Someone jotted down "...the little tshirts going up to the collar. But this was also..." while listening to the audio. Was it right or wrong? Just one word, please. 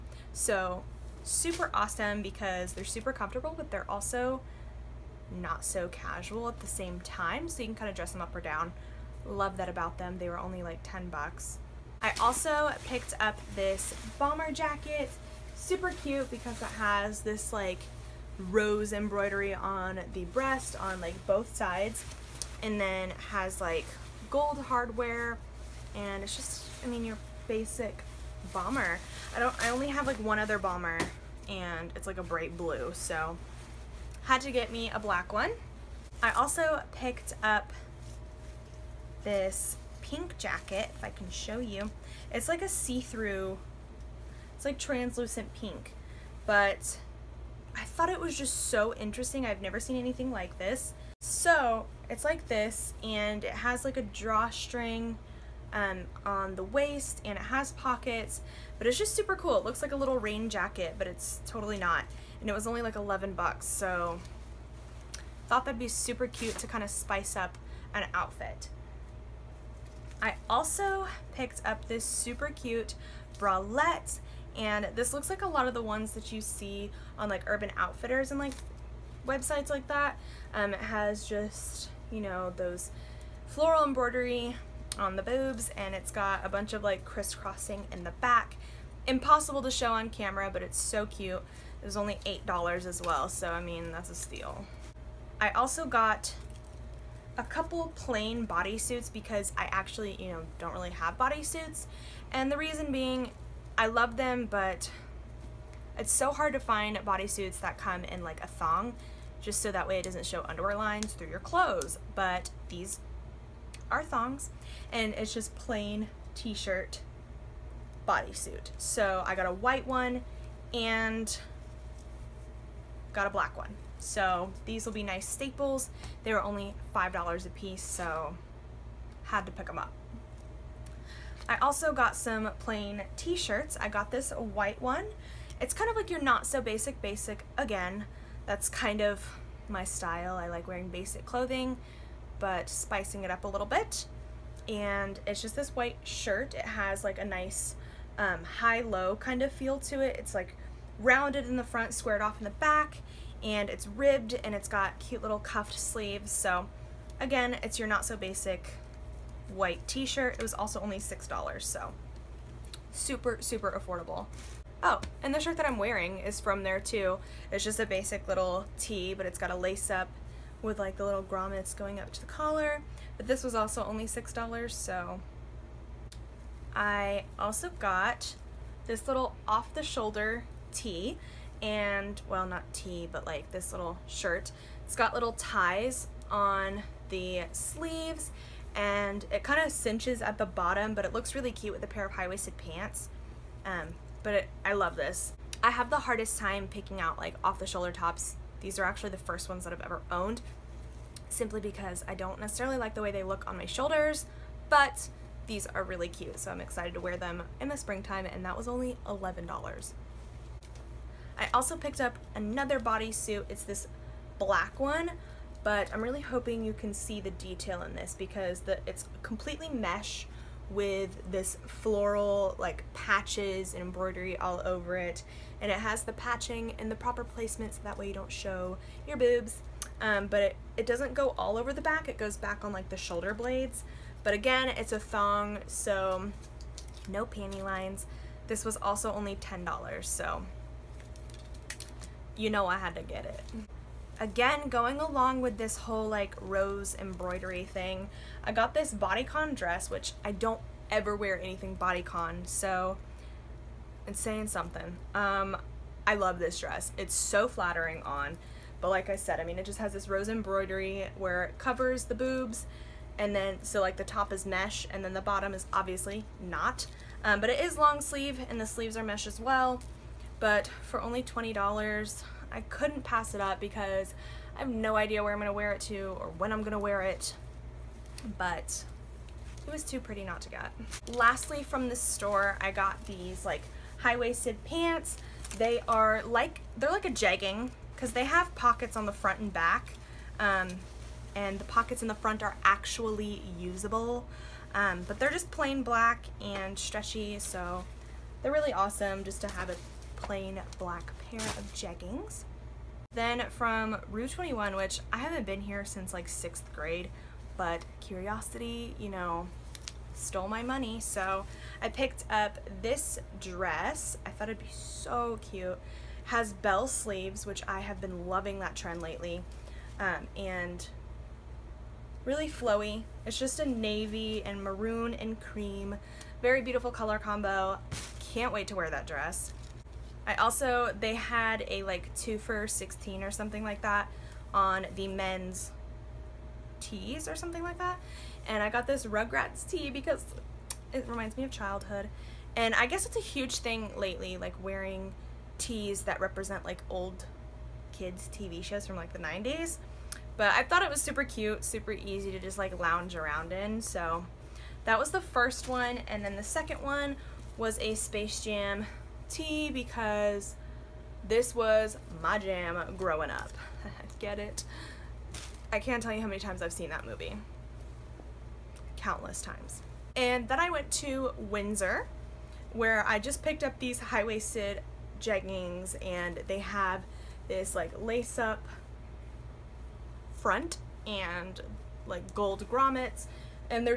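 wrong.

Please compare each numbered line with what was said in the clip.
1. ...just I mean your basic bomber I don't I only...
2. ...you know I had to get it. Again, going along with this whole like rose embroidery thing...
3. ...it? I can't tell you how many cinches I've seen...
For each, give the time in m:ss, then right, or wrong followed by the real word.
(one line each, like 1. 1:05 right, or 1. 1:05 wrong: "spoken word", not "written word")
1. 0:26 right
2. 4:02 right
3. 6:04 wrong: "times", not "cinches".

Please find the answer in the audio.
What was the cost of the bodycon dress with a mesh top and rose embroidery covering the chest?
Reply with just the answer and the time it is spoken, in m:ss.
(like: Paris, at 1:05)
$20, at 4:31.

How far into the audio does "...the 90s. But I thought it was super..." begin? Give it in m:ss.
5:49.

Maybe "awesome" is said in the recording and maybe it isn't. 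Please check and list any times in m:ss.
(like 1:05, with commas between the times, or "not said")
0:01, 4:58.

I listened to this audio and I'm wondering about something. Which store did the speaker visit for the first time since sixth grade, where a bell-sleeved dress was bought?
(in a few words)
Rue 21.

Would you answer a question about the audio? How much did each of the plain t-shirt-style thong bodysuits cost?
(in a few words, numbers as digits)
$5.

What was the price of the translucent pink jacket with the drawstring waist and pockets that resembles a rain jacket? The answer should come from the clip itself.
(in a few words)
$11.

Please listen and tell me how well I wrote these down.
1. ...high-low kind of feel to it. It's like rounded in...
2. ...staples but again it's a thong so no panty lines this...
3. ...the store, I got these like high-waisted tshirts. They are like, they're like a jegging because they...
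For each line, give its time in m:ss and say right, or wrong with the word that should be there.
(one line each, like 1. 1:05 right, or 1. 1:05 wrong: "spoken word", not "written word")
1. 2:28 right
2. 3:53 wrong: "blades", not "staples"
3. 4:41 wrong: "pants", not "tshirts".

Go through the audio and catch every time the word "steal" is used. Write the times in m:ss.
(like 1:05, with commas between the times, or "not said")
1:34.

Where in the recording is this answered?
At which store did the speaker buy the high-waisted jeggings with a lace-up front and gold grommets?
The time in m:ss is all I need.
6:11.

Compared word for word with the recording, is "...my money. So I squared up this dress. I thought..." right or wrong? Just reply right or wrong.
wrong.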